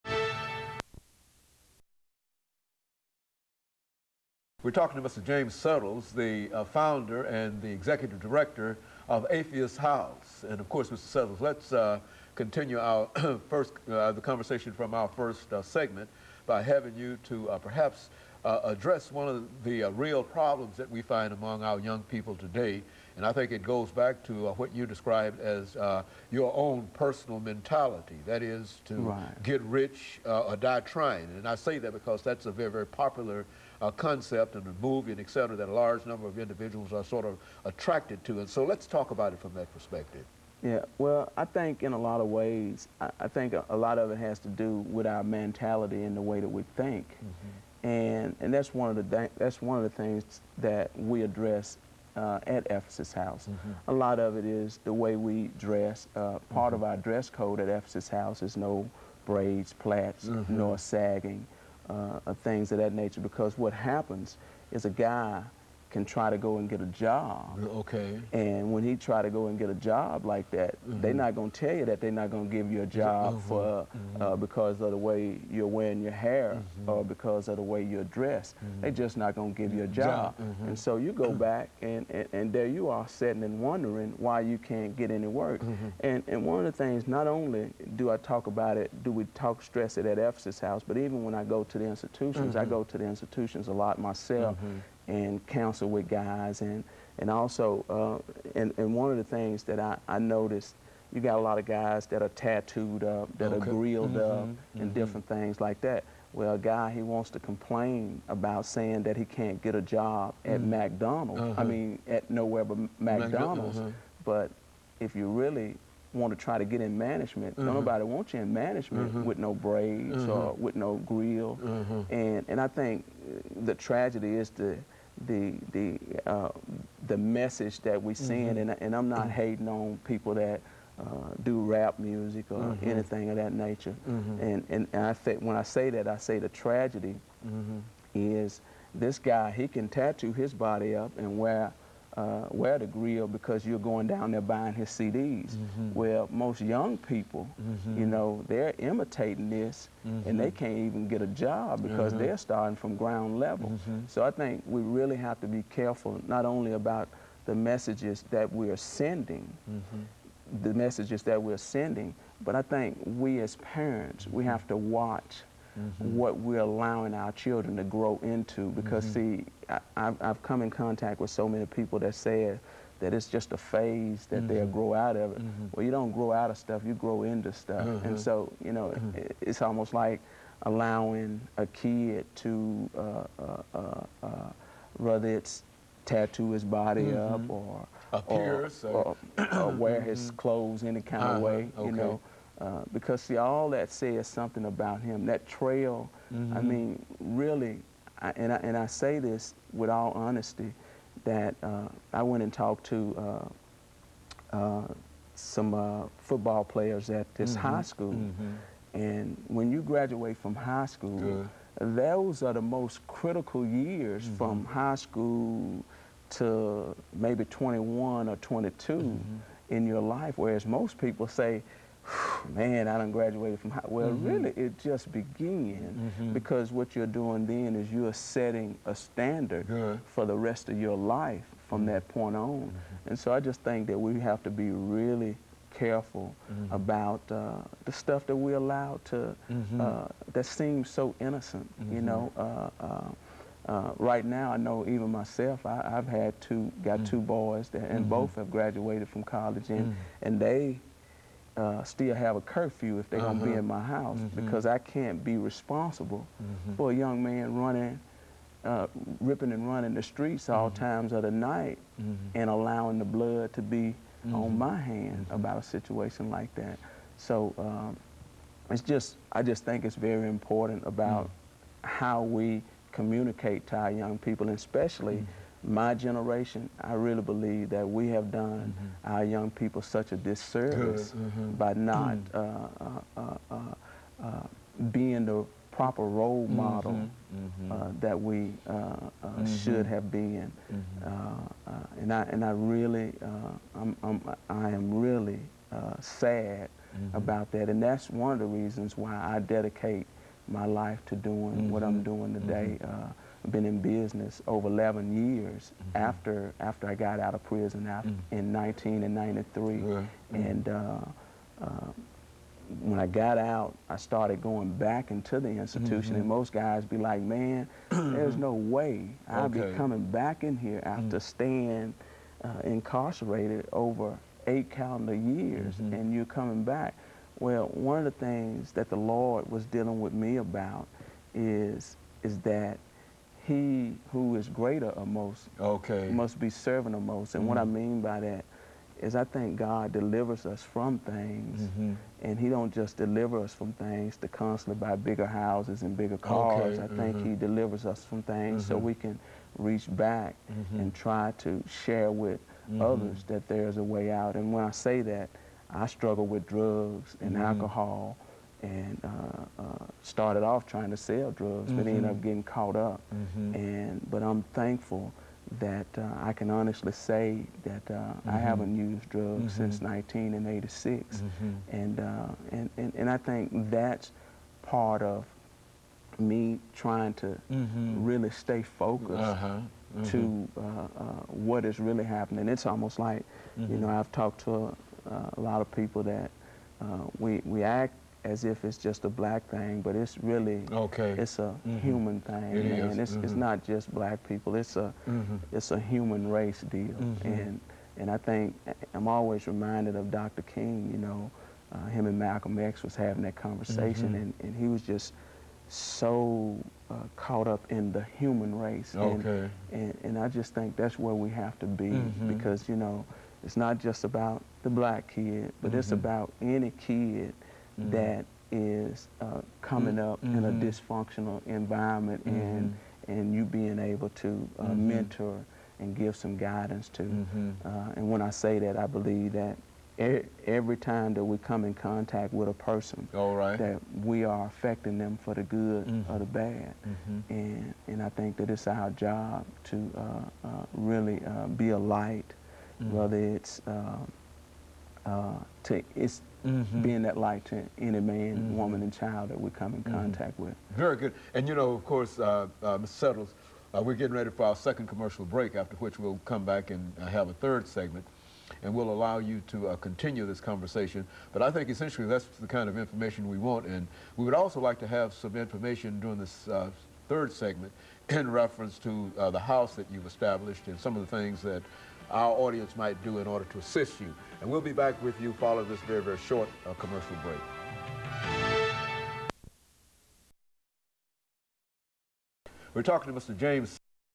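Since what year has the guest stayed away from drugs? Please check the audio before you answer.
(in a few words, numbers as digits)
1986.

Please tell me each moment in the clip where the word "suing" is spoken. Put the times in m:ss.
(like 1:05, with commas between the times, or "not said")
not said.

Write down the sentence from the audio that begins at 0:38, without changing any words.
And so let's talk about it from that perspective.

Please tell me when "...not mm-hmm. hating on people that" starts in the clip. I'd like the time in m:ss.
2:09.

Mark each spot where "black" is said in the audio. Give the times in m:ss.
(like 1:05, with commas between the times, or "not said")
6:29, 6:33, 6:54.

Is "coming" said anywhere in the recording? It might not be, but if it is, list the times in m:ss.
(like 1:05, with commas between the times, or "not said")
5:19, 5:26, 6:59.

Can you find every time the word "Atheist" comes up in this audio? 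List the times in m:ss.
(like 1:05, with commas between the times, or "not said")
0:09.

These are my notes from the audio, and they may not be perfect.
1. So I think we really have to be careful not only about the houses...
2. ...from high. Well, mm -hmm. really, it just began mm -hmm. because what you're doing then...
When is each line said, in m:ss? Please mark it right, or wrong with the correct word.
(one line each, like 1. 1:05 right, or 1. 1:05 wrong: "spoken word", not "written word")
1. 2:34 wrong: "messages", not "houses"
2. 3:43 right.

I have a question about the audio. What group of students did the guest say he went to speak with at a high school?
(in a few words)
Football players.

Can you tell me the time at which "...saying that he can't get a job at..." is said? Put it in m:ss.
1:48.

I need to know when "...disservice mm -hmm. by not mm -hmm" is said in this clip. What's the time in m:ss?
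4:40.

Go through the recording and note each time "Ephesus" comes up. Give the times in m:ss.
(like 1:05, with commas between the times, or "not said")
0:52, 0:57, 1:30.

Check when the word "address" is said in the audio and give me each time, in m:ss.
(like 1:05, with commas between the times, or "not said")
0:18, 0:51.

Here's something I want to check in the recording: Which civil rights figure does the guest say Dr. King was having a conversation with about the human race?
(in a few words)
Malcolm X.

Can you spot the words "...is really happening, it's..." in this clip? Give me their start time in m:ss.
6:21.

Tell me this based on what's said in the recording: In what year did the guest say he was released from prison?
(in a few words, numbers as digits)
1993.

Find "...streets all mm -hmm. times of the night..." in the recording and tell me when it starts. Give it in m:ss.
4:20.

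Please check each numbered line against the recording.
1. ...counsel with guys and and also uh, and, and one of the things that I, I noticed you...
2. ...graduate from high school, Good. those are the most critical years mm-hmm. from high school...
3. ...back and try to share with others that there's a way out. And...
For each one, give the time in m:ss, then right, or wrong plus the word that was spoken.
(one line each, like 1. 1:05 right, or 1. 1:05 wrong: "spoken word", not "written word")
1. 1:35 right
2. 3:29 right
3. 5:49 right.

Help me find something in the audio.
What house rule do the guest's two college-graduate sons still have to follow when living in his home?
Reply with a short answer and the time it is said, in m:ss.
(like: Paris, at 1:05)
A curfew, at 4:12.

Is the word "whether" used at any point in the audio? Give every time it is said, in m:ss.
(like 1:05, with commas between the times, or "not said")
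3:04, 7:22.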